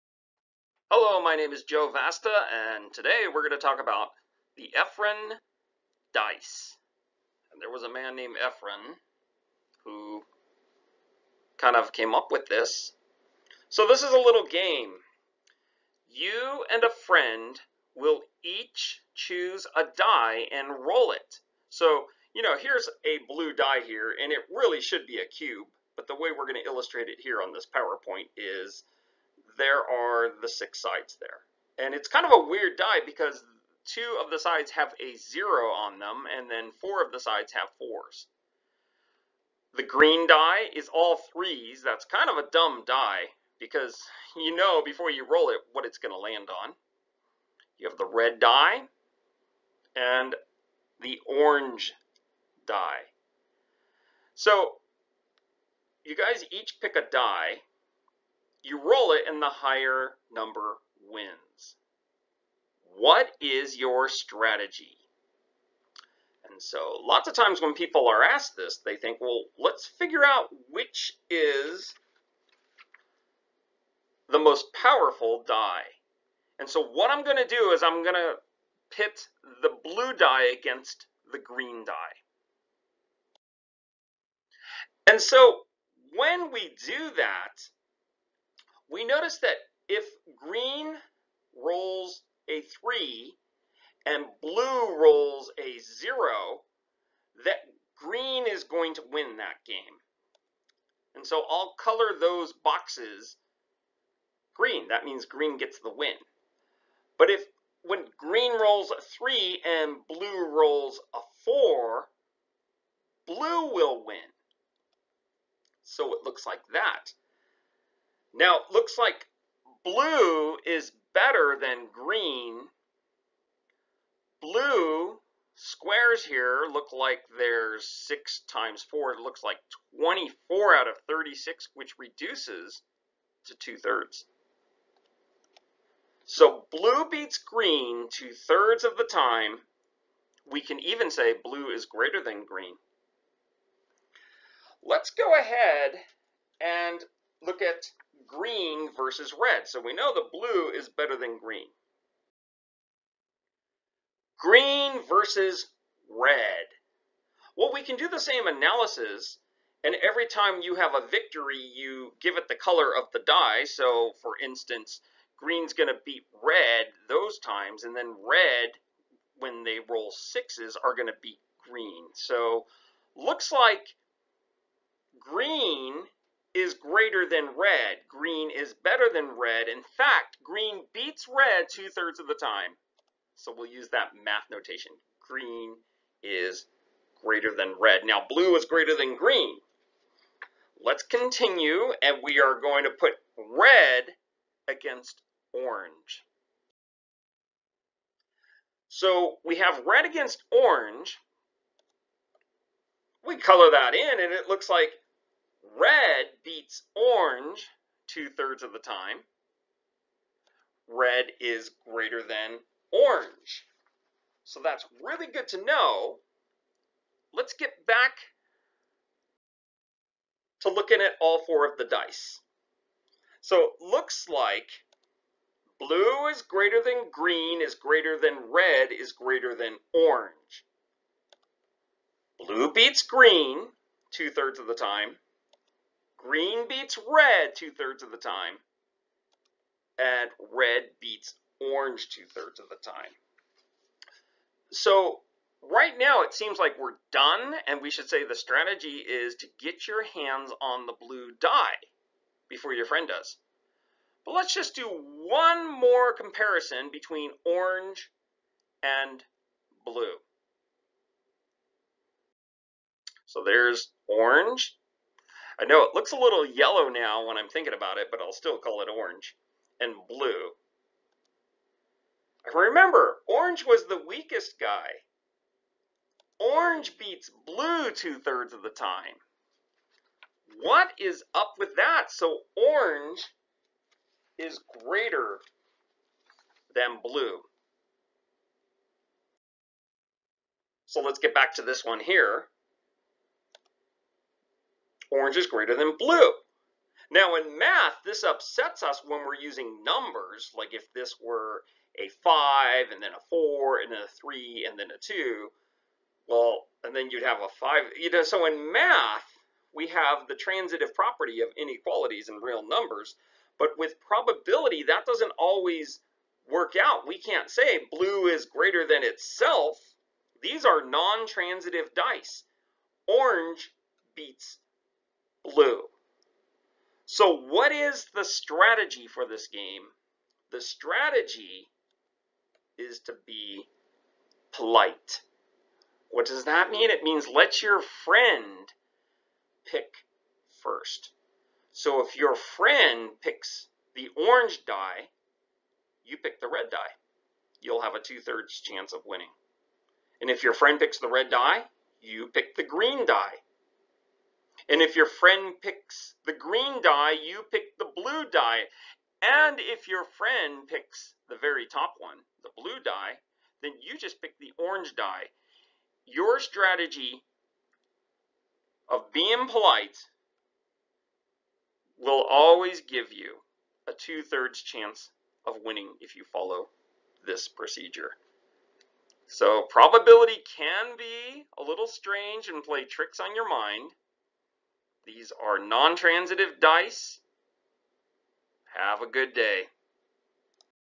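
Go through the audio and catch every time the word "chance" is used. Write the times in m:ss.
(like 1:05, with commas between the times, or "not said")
5:48, 6:14.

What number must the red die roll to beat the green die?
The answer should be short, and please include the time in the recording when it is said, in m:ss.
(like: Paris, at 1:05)
6, at 2:50.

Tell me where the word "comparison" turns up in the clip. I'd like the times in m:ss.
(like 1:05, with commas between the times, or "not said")
4:16.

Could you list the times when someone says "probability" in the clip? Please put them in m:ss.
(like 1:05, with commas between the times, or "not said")
5:13, 6:19.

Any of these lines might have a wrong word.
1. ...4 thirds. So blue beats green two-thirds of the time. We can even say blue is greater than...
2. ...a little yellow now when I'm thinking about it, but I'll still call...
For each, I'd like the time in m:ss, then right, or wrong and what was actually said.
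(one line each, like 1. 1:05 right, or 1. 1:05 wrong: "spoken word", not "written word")
1. 2:13 wrong: "2", not "4"
2. 4:26 right.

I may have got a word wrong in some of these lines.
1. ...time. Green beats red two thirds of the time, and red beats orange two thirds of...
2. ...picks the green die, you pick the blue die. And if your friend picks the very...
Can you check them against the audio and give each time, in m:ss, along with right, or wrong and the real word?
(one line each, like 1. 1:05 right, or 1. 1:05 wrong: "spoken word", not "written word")
1. 3:54 right
2. 5:55 right.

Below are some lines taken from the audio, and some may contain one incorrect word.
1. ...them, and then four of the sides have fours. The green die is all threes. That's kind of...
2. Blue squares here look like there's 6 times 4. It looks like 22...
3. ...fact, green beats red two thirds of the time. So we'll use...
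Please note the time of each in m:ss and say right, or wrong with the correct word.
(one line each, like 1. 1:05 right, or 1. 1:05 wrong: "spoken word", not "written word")
1. 0:35 right
2. 2:04 wrong: "24", not "22"
3. 2:59 right.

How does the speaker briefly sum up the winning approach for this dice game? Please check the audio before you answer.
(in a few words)
Be polite.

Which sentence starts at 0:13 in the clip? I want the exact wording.
So this is a little game.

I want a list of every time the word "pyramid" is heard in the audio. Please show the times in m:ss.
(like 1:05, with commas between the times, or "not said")
not said.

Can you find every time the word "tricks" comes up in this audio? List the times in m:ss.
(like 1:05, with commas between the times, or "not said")
6:22.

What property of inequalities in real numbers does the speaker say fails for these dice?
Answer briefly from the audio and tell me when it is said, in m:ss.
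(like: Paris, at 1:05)
Transitive property, at 5:10.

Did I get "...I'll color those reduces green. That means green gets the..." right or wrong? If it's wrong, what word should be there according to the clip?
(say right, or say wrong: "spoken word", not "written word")
wrong: "boxes", not "reduces".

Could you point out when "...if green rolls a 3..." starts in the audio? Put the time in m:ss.
1:29.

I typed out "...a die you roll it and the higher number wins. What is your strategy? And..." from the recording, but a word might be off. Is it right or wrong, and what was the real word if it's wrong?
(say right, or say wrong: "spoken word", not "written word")
right.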